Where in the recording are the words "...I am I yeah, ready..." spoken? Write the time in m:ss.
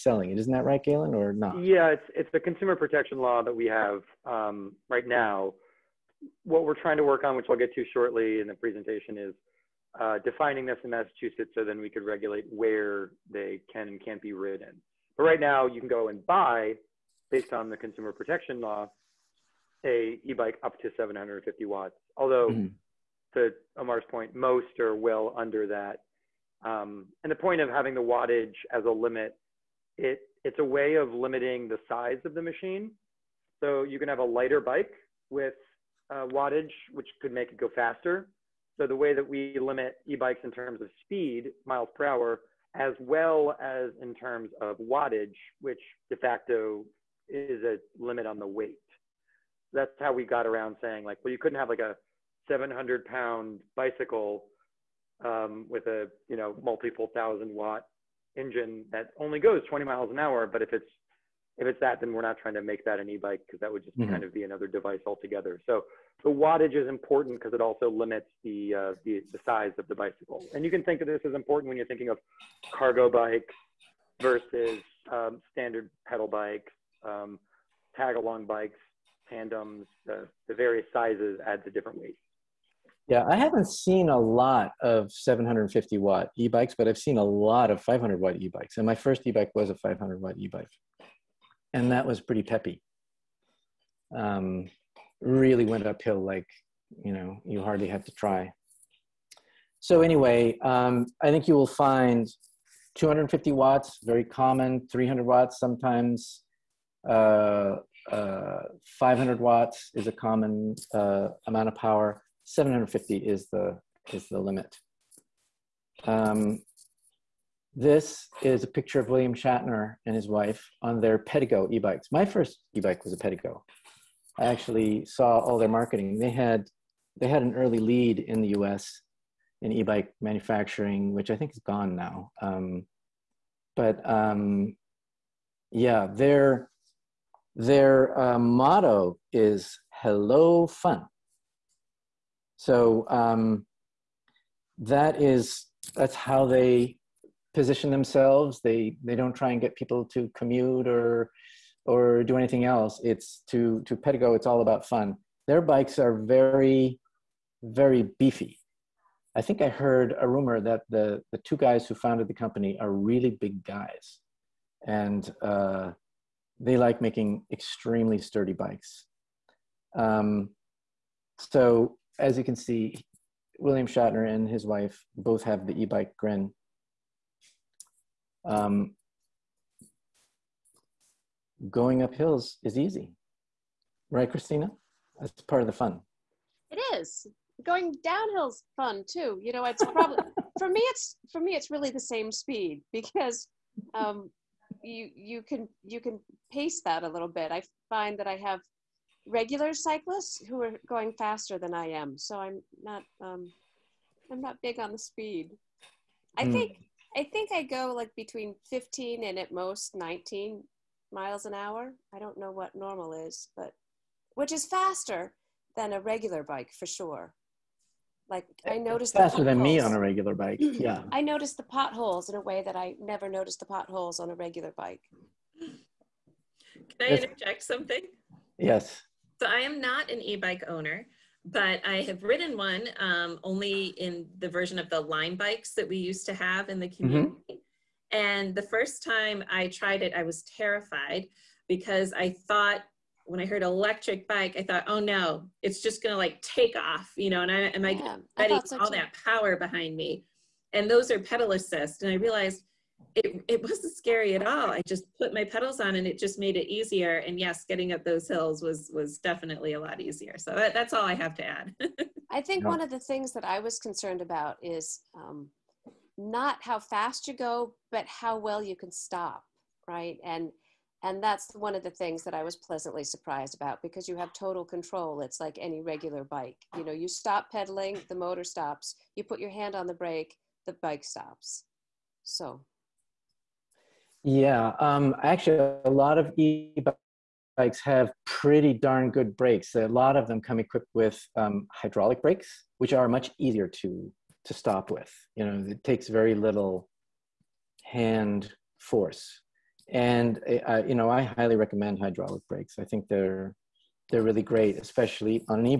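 4:07.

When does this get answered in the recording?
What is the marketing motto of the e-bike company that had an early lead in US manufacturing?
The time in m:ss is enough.
2:20.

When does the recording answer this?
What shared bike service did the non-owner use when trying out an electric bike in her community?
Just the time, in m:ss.
3:54.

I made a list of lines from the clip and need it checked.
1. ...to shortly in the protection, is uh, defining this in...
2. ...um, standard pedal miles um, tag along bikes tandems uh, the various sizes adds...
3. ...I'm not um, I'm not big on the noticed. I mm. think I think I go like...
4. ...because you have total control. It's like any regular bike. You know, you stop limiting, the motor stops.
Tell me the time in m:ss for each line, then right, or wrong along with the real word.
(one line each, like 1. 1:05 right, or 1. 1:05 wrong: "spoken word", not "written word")
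1. 0:07 wrong: "presentation", not "protection"
2. 1:15 wrong: "bikes", not "miles"
3. 3:22 wrong: "speed", not "noticed"
4. 4:33 wrong: "pedaling", not "limiting".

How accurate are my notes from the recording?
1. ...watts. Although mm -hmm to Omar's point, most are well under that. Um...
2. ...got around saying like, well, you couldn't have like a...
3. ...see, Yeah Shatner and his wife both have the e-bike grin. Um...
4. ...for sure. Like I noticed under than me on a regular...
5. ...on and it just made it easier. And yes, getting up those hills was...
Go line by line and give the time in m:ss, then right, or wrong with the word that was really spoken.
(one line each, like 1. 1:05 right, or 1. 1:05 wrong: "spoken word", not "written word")
1. 0:21 right
2. 0:50 right
3. 2:52 wrong: "William", not "Yeah"
4. 3:36 wrong: "faster", not "under"
5. 4:15 right.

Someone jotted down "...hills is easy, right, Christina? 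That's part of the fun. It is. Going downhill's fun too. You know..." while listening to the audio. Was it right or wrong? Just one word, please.
right.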